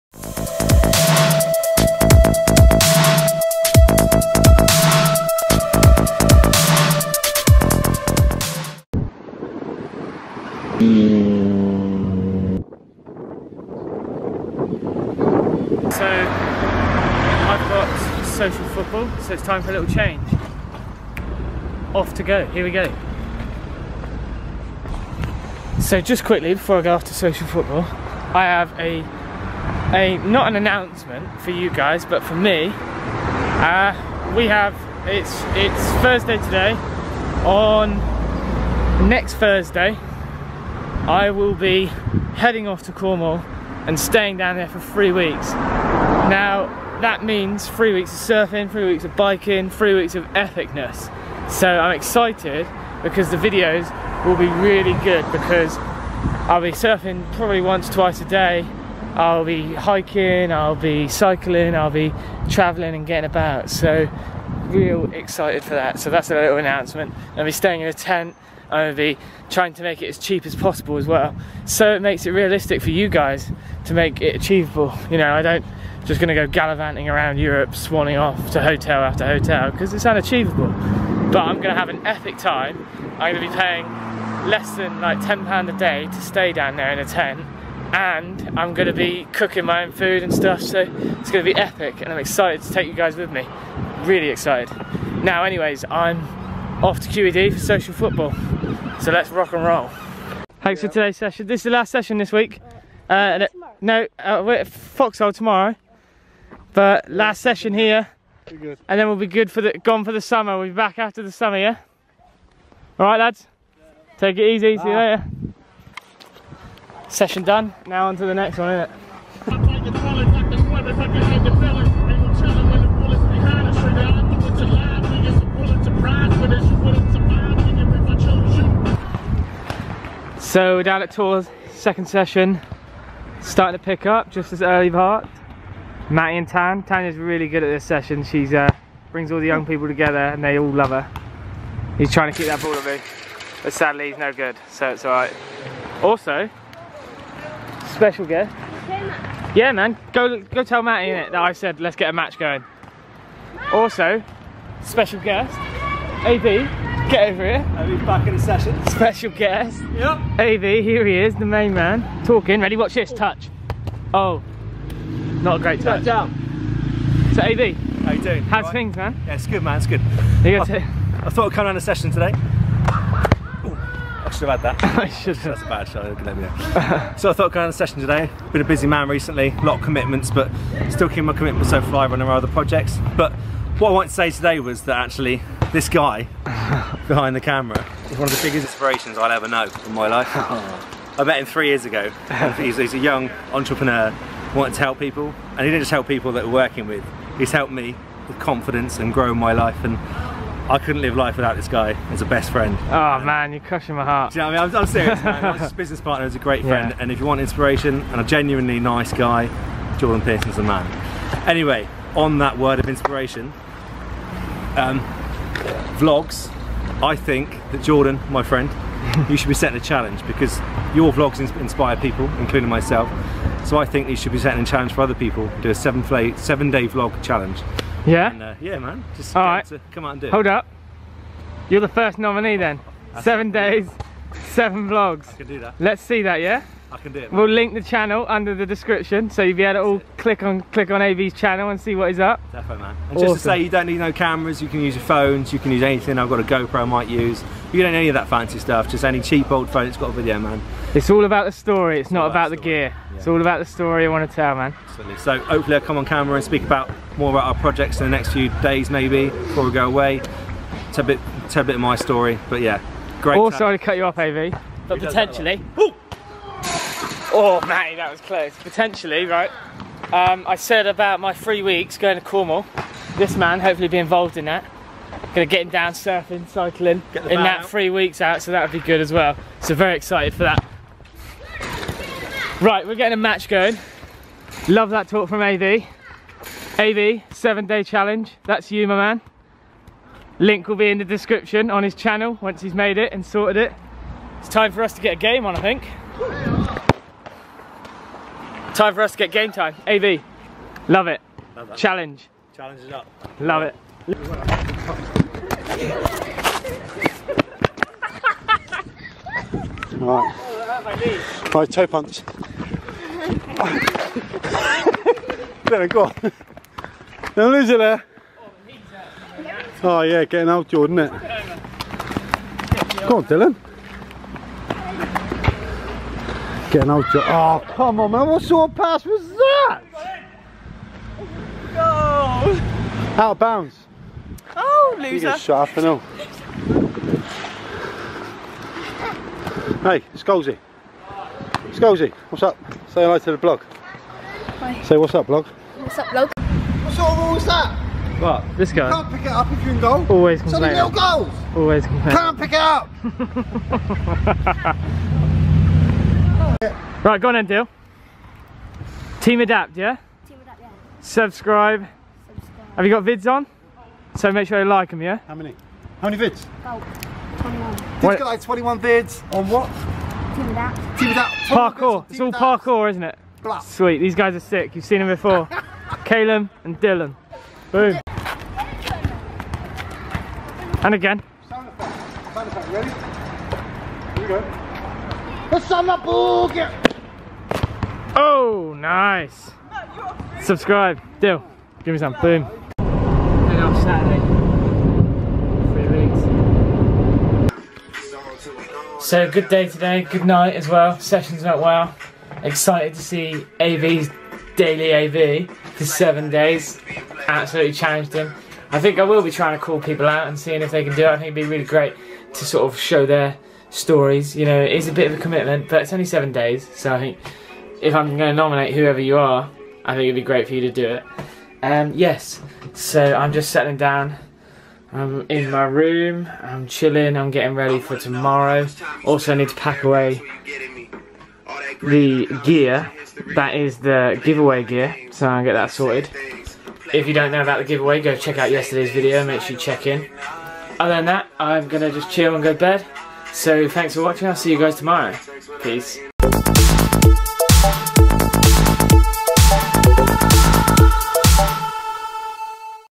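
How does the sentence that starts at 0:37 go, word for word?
On next Thursday, I will be heading off to Cornwall and staying down there for three weeks.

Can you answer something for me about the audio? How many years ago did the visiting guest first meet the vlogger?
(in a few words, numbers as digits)
3 years.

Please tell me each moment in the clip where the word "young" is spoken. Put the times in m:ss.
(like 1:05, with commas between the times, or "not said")
2:19, 3:12.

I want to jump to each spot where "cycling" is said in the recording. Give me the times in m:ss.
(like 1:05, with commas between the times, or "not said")
1:01, 4:36.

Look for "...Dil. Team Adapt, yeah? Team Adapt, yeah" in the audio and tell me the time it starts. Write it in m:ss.
5:57.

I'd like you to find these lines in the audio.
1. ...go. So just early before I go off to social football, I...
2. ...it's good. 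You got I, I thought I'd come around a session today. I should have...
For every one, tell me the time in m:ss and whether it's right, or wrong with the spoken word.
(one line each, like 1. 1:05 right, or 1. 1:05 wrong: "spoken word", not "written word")
1. 0:22 wrong: "quickly", not "early"
2. 2:49 right.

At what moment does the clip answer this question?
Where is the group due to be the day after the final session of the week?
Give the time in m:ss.
1:44.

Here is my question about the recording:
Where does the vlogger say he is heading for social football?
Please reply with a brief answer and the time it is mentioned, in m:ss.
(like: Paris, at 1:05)
QED, at 1:37.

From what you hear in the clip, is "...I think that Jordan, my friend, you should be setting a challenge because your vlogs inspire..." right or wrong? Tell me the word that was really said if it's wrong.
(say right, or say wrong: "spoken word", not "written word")
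right.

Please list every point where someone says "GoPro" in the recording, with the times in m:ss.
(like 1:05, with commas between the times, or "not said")
4:06.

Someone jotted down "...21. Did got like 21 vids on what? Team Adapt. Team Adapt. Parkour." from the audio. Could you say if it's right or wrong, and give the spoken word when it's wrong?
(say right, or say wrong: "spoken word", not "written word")
right.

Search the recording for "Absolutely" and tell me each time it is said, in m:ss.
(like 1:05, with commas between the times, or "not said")
4:14, 6:47.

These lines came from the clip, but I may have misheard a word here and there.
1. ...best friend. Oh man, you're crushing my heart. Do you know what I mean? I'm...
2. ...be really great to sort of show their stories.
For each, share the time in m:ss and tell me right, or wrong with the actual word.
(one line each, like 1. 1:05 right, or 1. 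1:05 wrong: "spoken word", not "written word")
1. 3:22 right
2. 6:51 right.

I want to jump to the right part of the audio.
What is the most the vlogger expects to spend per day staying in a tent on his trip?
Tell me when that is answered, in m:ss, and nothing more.
1:25.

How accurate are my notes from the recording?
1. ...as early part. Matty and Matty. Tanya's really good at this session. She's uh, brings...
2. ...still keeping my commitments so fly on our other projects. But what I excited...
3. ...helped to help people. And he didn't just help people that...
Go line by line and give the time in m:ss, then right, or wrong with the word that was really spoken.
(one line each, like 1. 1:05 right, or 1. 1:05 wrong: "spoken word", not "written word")
1. 2:14 wrong: "Tan", not "Matty"
2. 3:00 wrong: "wanted", not "excited"
3. 3:14 wrong: "wanted", not "helped".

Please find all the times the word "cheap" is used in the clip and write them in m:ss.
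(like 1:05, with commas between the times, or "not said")
1:10, 4:09.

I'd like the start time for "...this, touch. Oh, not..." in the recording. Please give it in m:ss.
2:42.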